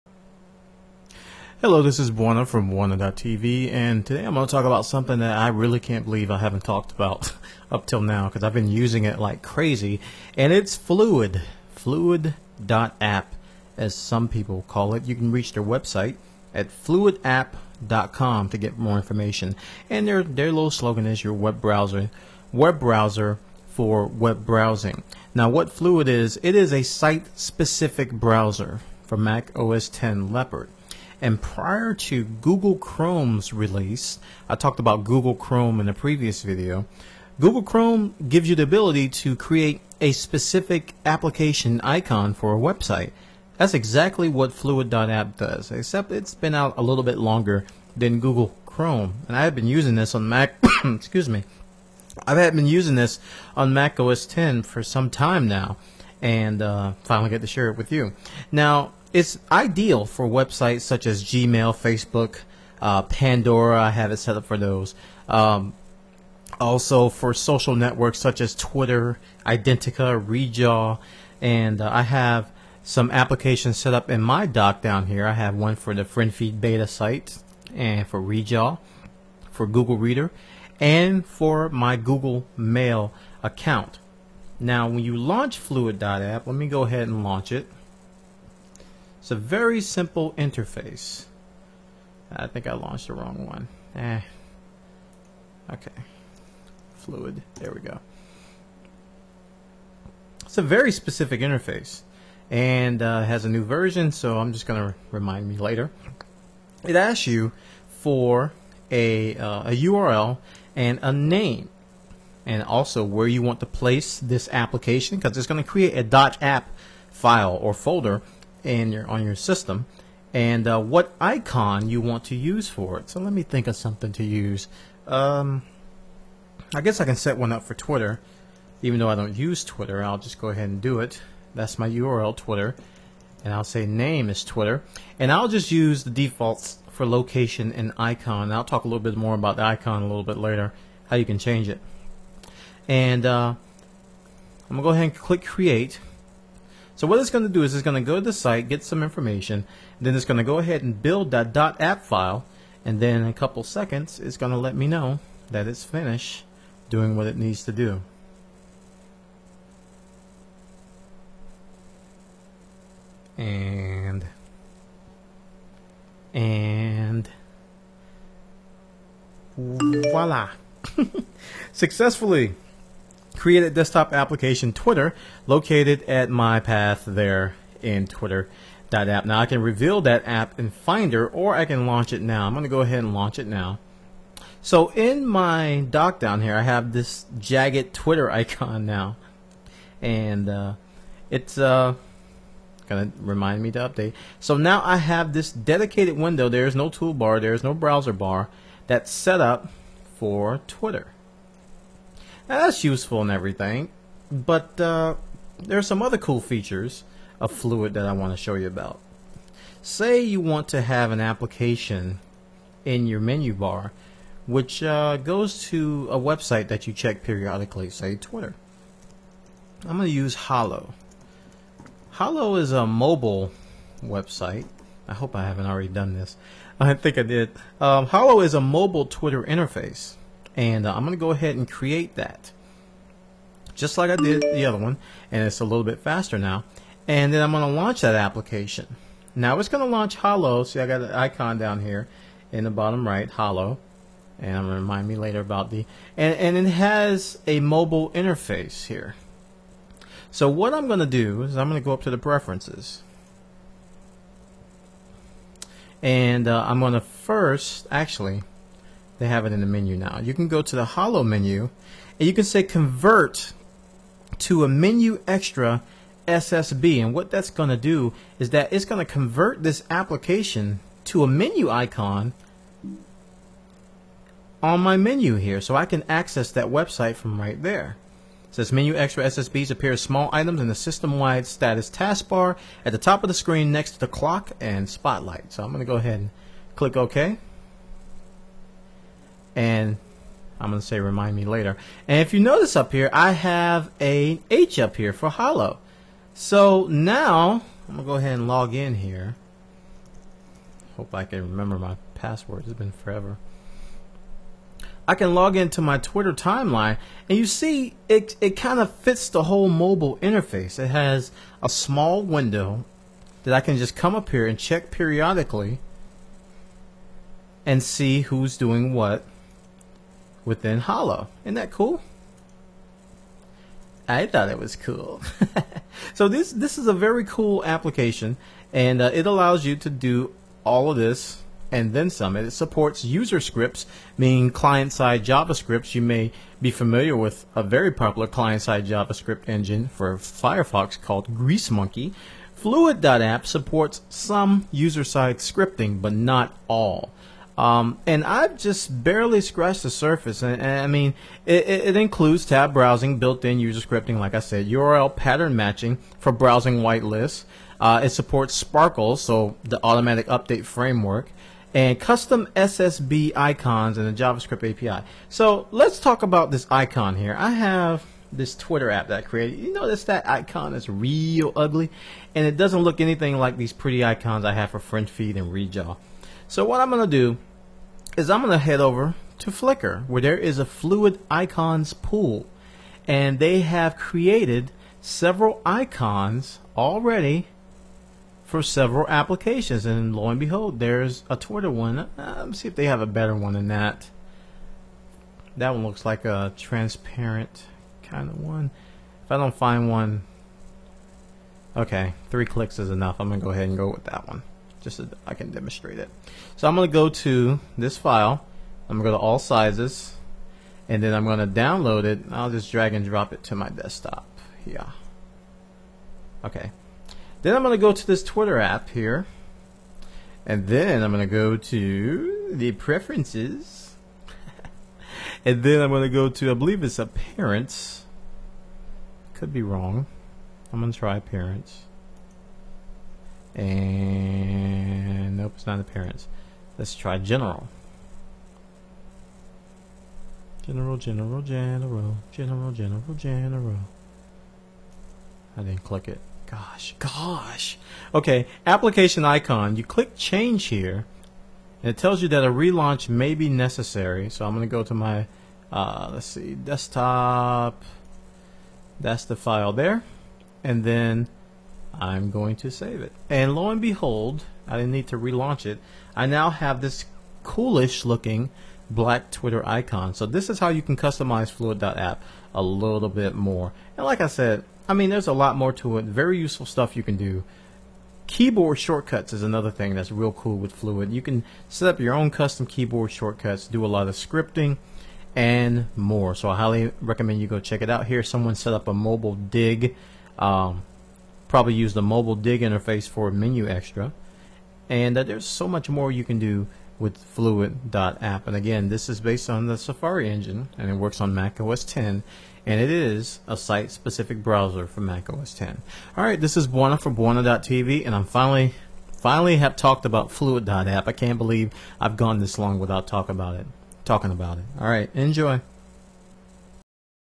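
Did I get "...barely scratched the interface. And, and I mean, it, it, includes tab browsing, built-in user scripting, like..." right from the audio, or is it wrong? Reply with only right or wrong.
wrong.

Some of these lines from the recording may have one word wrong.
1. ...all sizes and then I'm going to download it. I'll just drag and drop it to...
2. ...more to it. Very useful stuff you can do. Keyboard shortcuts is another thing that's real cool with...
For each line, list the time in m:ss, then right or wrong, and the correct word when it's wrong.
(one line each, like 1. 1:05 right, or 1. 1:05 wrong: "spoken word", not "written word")
1. 6:49 right
2. 7:55 right.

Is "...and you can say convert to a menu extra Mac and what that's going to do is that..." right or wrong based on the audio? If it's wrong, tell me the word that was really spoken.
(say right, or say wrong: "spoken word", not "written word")
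wrong: "SSB", not "Mac".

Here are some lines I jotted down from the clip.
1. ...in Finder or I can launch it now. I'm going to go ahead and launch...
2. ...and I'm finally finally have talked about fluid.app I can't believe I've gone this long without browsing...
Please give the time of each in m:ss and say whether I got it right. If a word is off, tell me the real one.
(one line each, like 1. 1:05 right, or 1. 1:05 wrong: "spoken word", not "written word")
1. 3:00 right
2. 8:28 wrong: "talking", not "browsing".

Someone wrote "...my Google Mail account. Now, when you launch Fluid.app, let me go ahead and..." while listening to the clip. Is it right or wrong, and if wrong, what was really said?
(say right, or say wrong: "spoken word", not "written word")
right.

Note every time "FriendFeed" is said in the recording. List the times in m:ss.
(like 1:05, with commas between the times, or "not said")
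1:16, 6:14.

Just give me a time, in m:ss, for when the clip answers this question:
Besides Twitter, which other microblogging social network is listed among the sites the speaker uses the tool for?
1:09.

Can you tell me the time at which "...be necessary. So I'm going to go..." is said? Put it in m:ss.
7:33.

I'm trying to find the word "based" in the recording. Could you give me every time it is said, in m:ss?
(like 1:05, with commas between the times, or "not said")
8:19.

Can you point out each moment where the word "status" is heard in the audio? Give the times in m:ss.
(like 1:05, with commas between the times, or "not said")
4:41.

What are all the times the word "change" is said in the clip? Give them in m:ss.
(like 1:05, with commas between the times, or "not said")
2:21, 7:30.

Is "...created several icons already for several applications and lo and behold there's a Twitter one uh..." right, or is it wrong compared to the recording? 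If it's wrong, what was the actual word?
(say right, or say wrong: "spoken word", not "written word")
right.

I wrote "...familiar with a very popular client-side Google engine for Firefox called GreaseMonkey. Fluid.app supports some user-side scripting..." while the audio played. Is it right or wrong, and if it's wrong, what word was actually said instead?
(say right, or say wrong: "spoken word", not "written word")
wrong: "JavaScript", not "Google".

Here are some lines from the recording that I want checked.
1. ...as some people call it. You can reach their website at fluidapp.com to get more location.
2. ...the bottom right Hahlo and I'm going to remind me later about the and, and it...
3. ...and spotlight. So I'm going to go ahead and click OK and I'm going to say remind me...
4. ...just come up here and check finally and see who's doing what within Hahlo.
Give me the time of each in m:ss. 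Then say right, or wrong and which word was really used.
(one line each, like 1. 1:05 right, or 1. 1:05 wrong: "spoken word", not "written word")
1. 0:13 wrong: "information", not "location"
2. 4:02 right
3. 4:44 right
4. 5:13 wrong: "periodically", not "finally".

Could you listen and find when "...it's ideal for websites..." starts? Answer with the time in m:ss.
0:59.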